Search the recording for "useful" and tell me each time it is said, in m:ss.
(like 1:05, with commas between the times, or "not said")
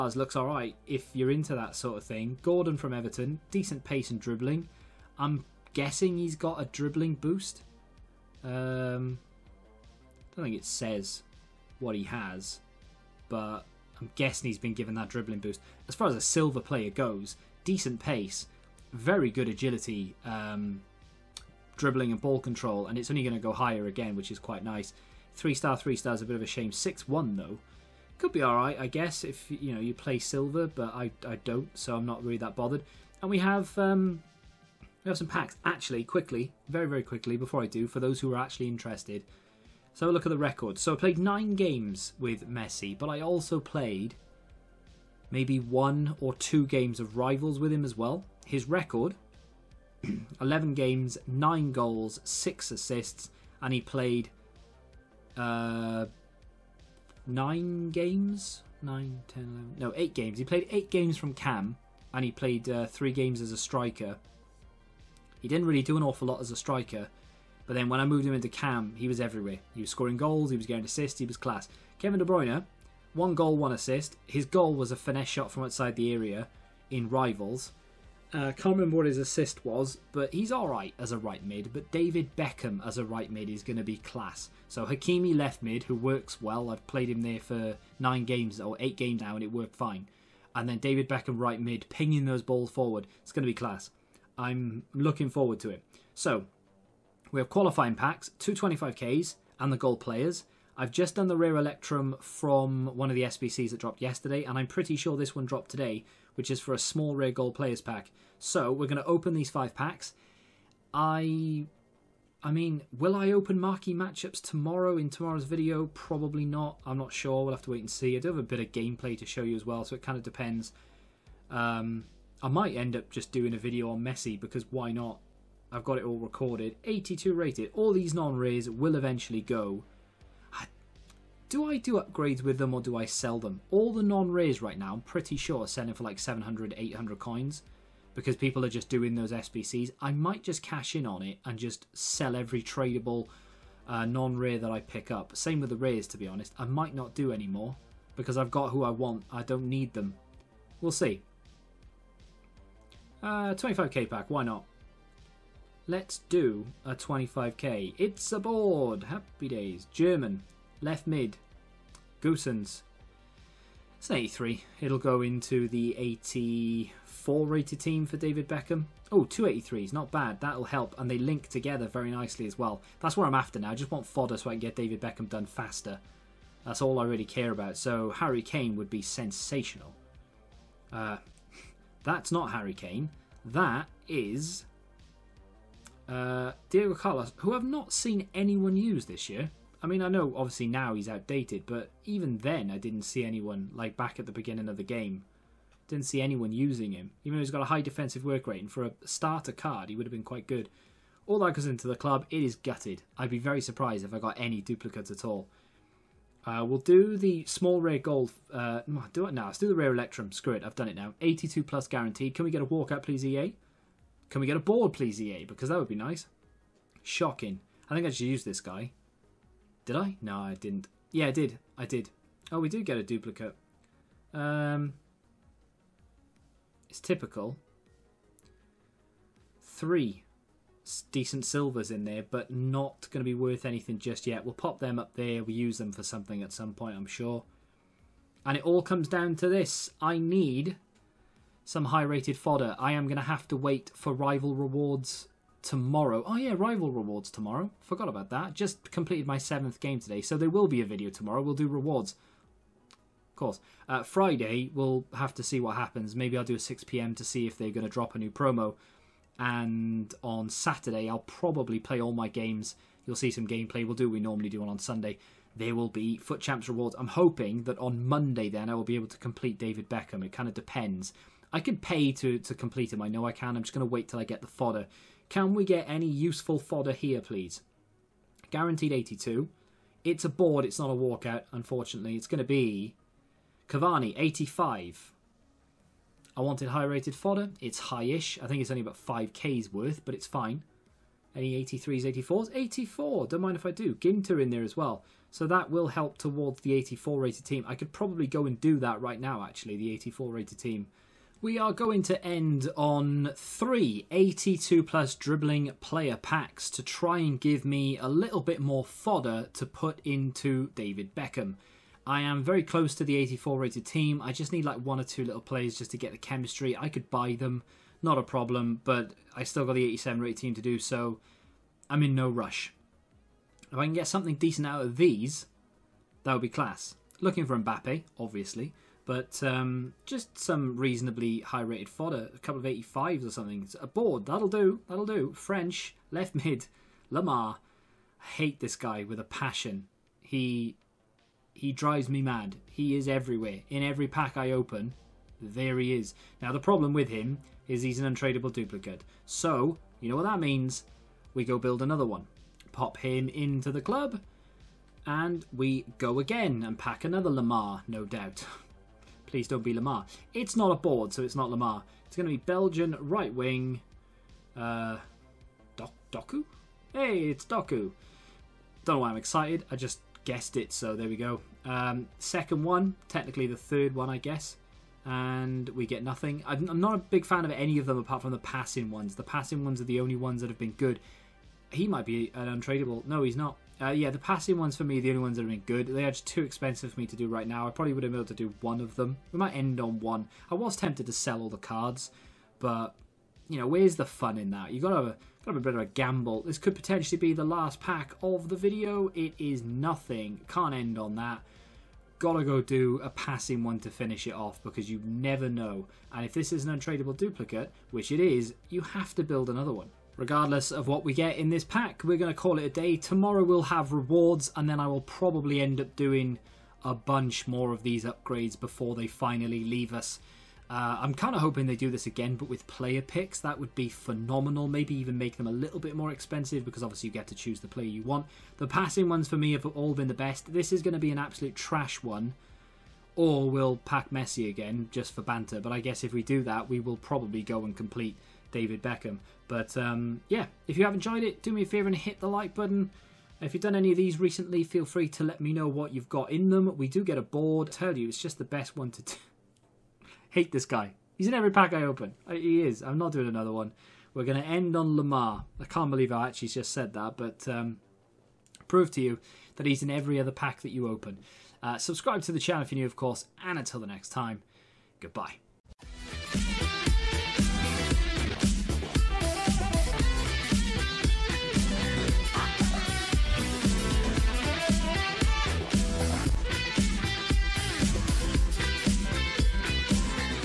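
4:36.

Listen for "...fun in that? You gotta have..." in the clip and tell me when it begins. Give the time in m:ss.
6:34.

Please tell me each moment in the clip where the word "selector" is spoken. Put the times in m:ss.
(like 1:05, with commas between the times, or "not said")
not said.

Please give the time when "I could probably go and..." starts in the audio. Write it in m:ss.
4:57.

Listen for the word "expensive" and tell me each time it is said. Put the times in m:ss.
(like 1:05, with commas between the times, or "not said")
6:26, 7:06.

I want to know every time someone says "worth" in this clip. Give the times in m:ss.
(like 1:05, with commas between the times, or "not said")
3:53, 4:49.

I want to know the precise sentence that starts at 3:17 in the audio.
Even though he's got a high defensive work rate, and for a starter card, he would have been quite good.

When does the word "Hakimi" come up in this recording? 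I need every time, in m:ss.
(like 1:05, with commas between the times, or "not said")
1:24.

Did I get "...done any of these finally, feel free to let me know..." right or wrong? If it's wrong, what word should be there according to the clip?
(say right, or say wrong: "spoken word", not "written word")
wrong: "recently", not "finally".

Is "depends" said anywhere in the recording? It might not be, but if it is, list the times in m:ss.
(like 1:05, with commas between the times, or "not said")
2:00, 4:30.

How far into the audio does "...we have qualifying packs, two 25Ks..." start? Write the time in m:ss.
1:37.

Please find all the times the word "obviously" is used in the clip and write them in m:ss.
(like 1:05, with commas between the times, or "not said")
3:10, 5:28, 7:06.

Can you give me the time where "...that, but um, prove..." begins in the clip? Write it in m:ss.
7:36.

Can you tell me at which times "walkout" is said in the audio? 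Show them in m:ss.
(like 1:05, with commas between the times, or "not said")
3:32, 4:40.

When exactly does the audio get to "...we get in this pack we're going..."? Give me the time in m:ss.
6:51.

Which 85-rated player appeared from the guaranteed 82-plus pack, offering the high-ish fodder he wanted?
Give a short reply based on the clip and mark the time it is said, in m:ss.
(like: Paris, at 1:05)
Cavani, at 4:43.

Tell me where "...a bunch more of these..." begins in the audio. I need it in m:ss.
6:56.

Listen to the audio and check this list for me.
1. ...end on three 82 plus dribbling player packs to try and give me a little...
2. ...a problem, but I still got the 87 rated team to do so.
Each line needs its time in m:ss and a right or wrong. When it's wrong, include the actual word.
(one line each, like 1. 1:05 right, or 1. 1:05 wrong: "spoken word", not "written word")
1. 5:02 right
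2. 5:18 right.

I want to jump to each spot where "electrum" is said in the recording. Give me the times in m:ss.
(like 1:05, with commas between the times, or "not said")
1:41, 3:29.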